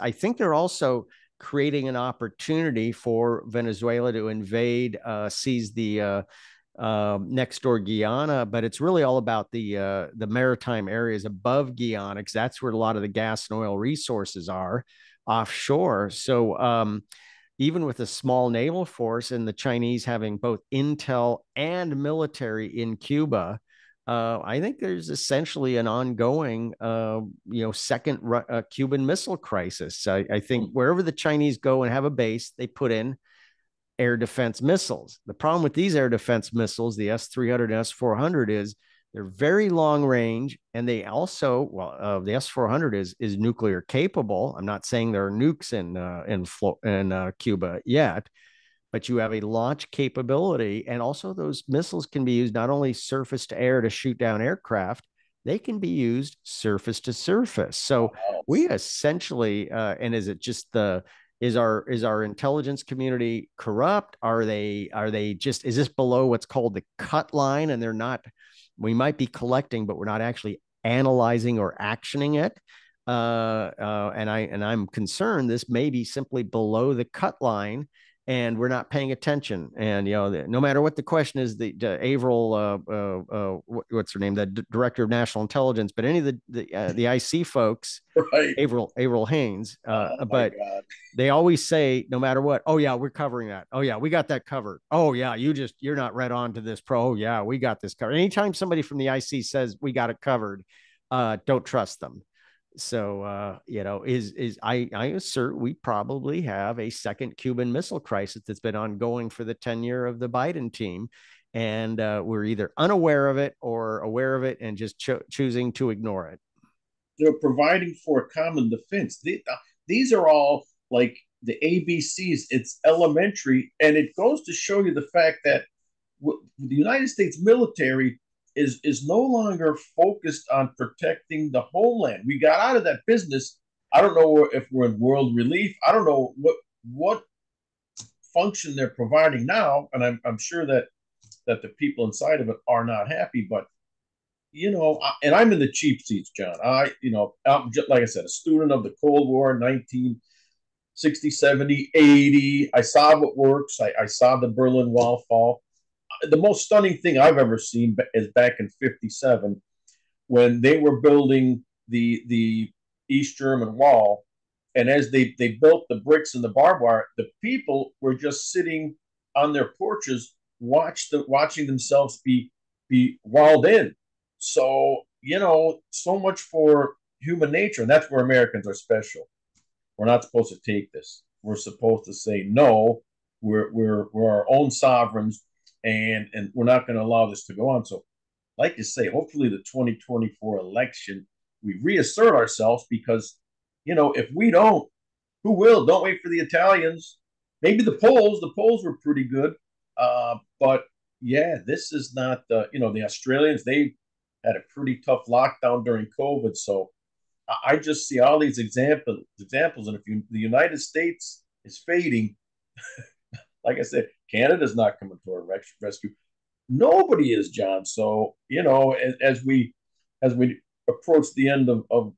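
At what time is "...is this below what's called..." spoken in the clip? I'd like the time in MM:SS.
01:05.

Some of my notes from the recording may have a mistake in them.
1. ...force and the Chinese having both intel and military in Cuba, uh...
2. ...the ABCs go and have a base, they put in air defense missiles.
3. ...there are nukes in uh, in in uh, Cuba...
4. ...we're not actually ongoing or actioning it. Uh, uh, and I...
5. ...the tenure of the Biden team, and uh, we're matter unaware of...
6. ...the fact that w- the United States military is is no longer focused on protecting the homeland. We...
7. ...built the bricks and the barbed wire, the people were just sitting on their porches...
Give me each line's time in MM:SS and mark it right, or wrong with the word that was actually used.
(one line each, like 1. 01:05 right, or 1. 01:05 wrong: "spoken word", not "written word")
1. 00:18 right
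2. 00:31 wrong: "Chinese", not "ABCs"
3. 00:45 right
4. 01:09 wrong: "analyzing", not "ongoing"
5. 01:49 wrong: "either", not "matter"
6. 02:04 right
7. 02:45 right.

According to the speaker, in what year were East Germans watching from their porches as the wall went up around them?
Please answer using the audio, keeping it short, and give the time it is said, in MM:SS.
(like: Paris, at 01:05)
1957, at 02:38.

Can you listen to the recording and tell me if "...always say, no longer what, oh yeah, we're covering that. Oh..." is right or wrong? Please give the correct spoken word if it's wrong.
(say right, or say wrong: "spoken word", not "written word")
wrong: "matter", not "longer".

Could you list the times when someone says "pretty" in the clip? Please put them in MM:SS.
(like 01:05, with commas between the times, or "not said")
03:19, 03:24.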